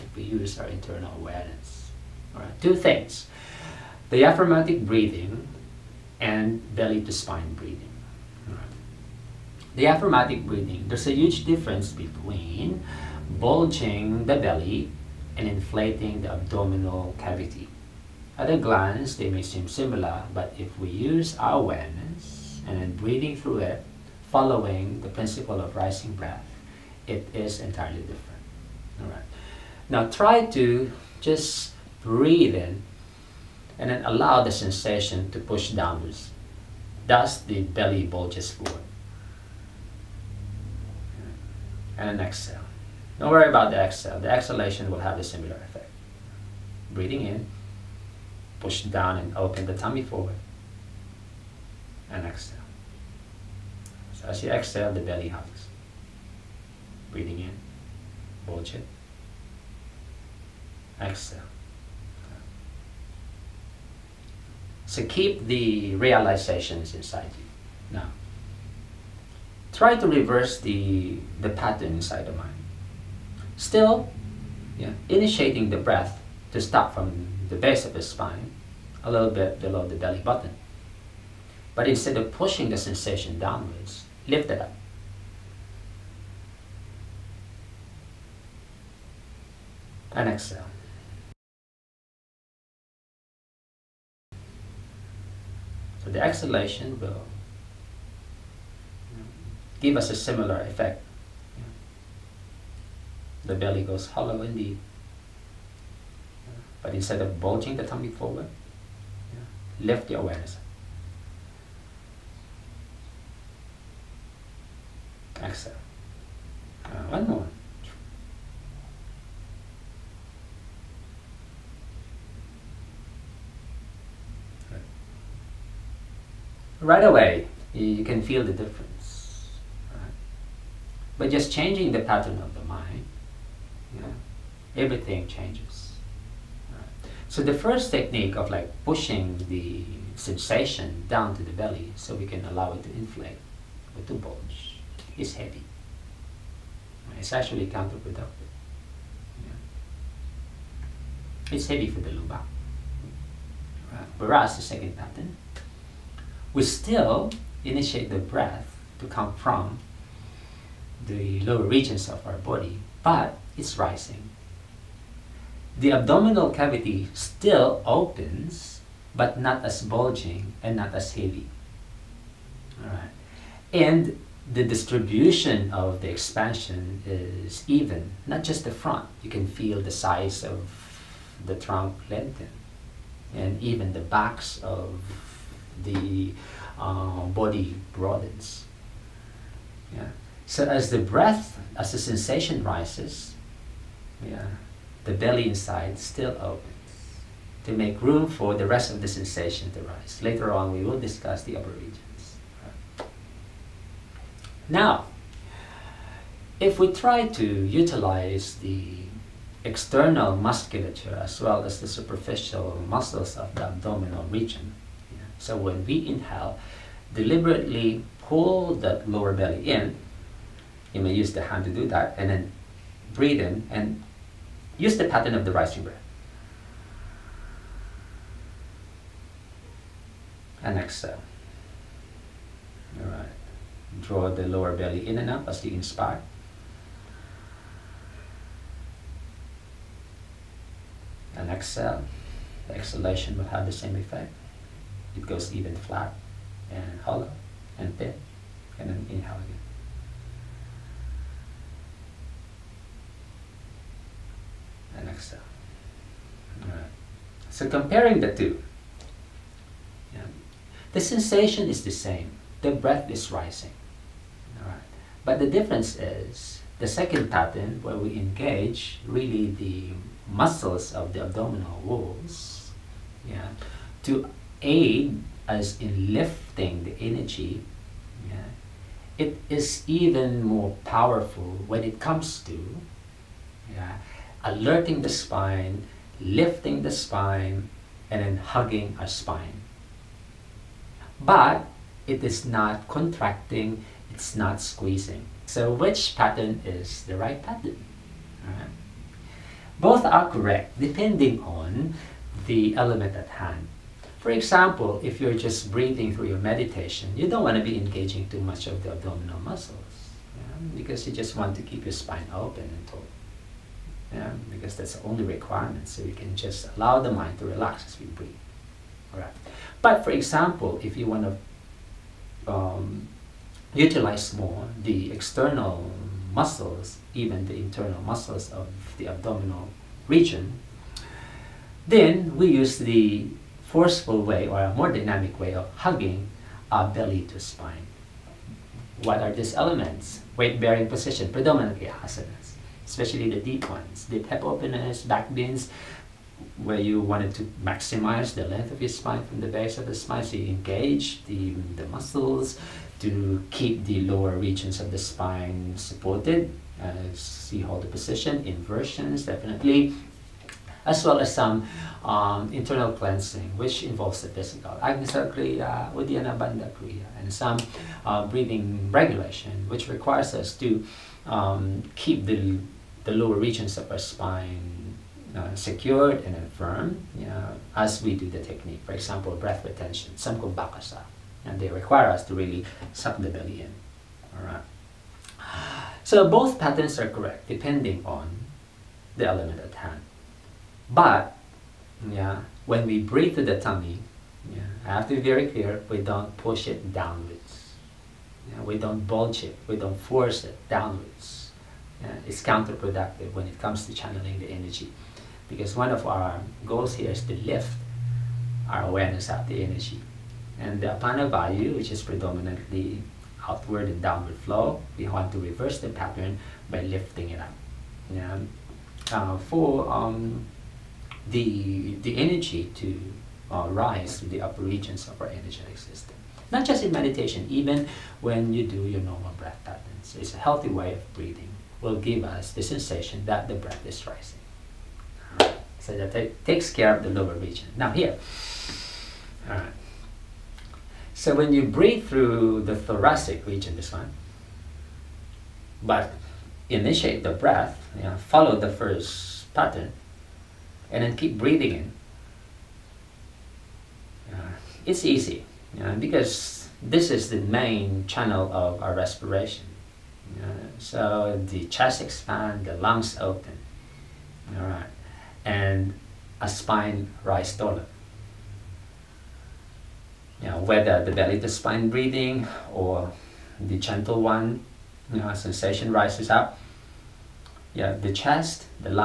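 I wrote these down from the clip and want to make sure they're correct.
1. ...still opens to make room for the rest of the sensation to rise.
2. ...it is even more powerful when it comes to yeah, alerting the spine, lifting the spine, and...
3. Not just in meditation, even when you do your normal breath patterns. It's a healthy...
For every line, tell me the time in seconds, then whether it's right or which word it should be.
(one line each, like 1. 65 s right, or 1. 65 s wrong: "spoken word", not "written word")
1. 195 s right
2. 279 s right
3. 426 s right.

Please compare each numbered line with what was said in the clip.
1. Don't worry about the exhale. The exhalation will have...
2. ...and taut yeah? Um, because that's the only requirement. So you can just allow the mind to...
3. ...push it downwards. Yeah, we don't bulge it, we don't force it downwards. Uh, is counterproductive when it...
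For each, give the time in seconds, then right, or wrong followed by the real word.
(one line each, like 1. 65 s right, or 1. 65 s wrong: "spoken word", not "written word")
1. 43 s right
2. 312 s right
3. 396 s right.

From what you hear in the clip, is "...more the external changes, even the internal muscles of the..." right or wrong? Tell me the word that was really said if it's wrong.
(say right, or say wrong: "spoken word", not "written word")
wrong: "muscles", not "changes".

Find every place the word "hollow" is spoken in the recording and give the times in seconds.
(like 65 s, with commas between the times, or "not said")
104 s, 247 s.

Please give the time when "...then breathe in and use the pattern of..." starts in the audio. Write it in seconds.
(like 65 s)
222 s.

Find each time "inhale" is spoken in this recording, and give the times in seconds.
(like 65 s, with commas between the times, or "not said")
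216 s, 249 s.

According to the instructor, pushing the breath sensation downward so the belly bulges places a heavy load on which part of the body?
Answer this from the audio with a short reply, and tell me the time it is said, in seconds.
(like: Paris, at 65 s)
the lumbar, at 151 s.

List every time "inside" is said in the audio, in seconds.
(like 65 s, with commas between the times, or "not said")
66 s, 71 s, 195 s.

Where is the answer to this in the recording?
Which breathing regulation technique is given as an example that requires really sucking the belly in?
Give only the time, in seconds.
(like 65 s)
379 s.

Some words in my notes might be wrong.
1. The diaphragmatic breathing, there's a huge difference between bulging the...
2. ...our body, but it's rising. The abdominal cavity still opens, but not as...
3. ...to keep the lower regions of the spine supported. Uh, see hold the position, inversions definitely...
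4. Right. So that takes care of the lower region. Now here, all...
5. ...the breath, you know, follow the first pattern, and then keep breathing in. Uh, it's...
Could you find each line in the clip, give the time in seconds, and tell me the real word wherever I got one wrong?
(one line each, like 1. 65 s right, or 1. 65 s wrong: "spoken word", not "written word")
1. 9 s right
2. 162 s right
3. 352 s right
4. 435 s right
5. 447 s right.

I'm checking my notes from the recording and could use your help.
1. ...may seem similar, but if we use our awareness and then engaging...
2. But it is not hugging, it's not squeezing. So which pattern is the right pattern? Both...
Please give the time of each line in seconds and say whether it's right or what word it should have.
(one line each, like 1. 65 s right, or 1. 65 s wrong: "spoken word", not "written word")
1. 19 s wrong: "breathing", not "engaging"
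2. 291 s wrong: "contracting", not "hugging".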